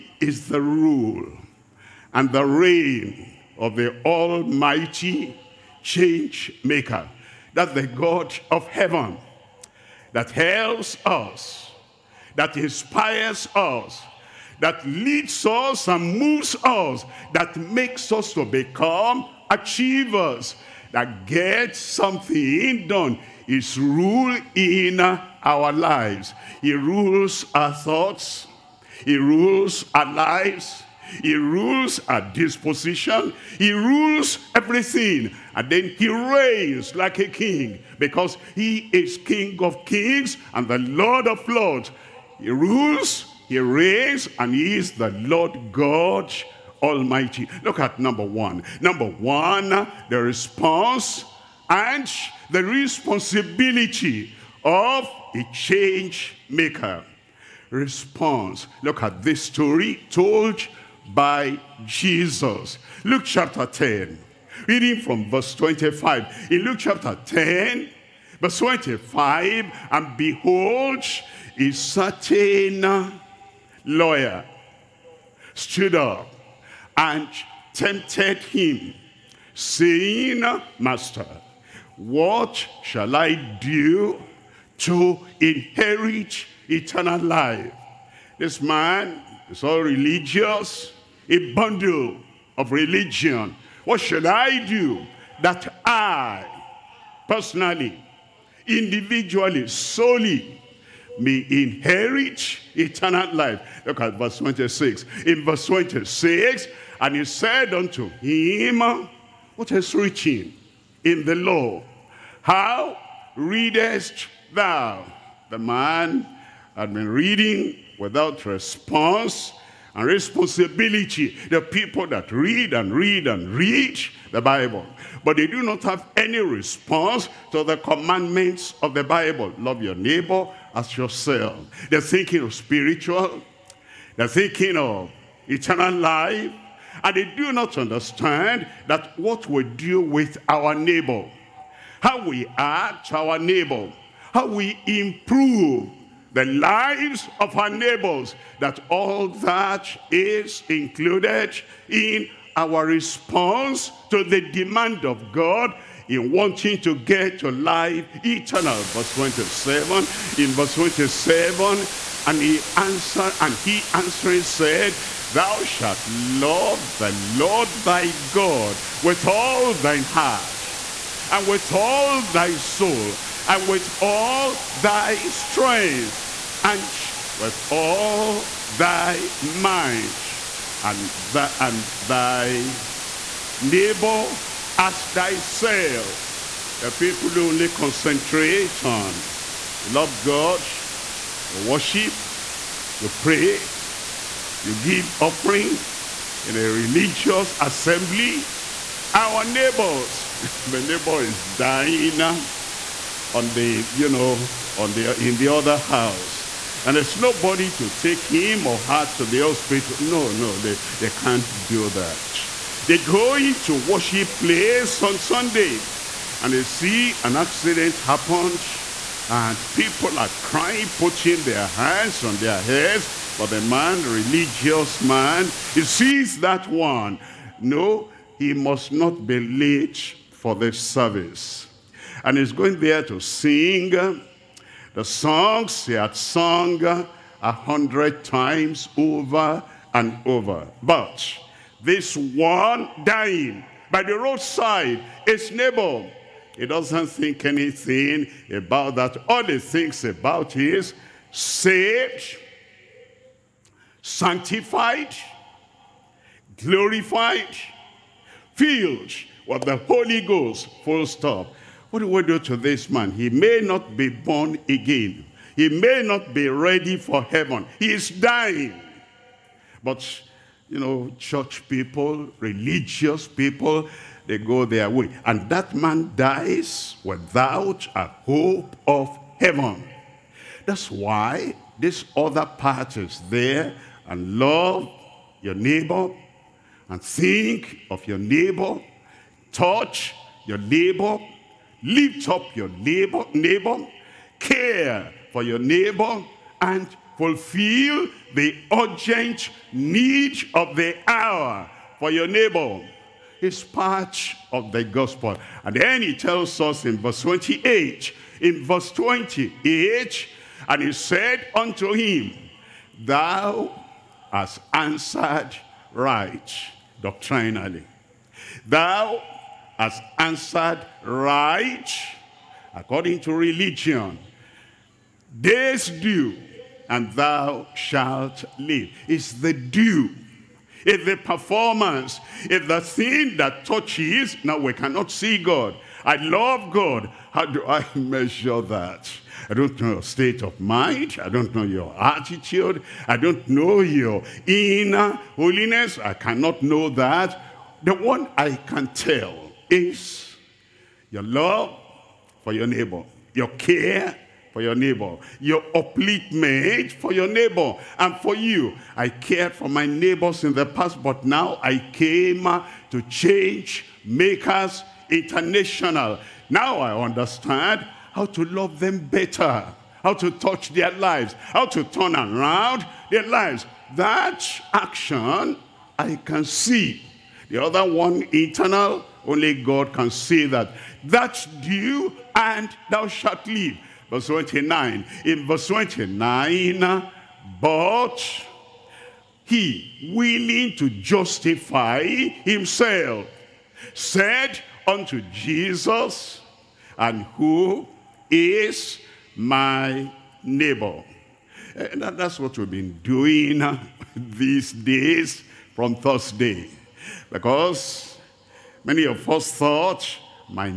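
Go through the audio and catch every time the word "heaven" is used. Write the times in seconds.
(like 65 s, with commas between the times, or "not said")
8 s, 267 s, 279 s.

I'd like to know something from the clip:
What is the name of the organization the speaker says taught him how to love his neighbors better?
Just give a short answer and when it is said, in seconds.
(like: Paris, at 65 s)
Change Makers International, at 363 s.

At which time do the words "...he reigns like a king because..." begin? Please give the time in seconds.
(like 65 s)
35 s.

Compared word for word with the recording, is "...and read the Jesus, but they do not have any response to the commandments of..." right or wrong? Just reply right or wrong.
wrong.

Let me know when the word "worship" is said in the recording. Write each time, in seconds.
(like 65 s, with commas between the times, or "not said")
191 s, 213 s.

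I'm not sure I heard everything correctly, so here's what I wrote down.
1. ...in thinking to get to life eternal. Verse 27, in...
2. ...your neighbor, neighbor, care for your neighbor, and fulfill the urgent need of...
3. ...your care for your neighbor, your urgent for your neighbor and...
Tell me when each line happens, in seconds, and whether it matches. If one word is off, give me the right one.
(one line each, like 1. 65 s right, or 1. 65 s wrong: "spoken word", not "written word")
1. 156 s wrong: "wanting", not "thinking"
2. 292 s right
3. 353 s wrong: "upliftment", not "urgent".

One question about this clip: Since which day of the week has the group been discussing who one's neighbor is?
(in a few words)
Thursday.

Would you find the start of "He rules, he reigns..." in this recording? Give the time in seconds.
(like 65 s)
42 s.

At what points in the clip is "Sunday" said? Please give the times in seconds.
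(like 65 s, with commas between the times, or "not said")
215 s.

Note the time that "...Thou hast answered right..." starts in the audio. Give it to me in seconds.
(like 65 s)
312 s.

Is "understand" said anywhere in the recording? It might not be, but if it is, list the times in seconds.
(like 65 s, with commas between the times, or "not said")
137 s, 367 s.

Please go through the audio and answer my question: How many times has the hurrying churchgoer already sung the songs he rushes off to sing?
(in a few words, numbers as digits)
100.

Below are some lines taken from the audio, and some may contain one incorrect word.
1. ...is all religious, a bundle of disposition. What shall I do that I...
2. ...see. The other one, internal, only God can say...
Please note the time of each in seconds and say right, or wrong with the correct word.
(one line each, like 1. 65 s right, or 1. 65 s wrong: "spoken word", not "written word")
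1. 89 s wrong: "religion", not "disposition"
2. 376 s right.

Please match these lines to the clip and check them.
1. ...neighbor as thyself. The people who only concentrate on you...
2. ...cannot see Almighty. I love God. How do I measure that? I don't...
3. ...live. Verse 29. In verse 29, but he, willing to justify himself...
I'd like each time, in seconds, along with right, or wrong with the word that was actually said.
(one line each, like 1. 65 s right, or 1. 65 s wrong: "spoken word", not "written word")
1. 183 s right
2. 334 s wrong: "God", not "Almighty"
3. 383 s right.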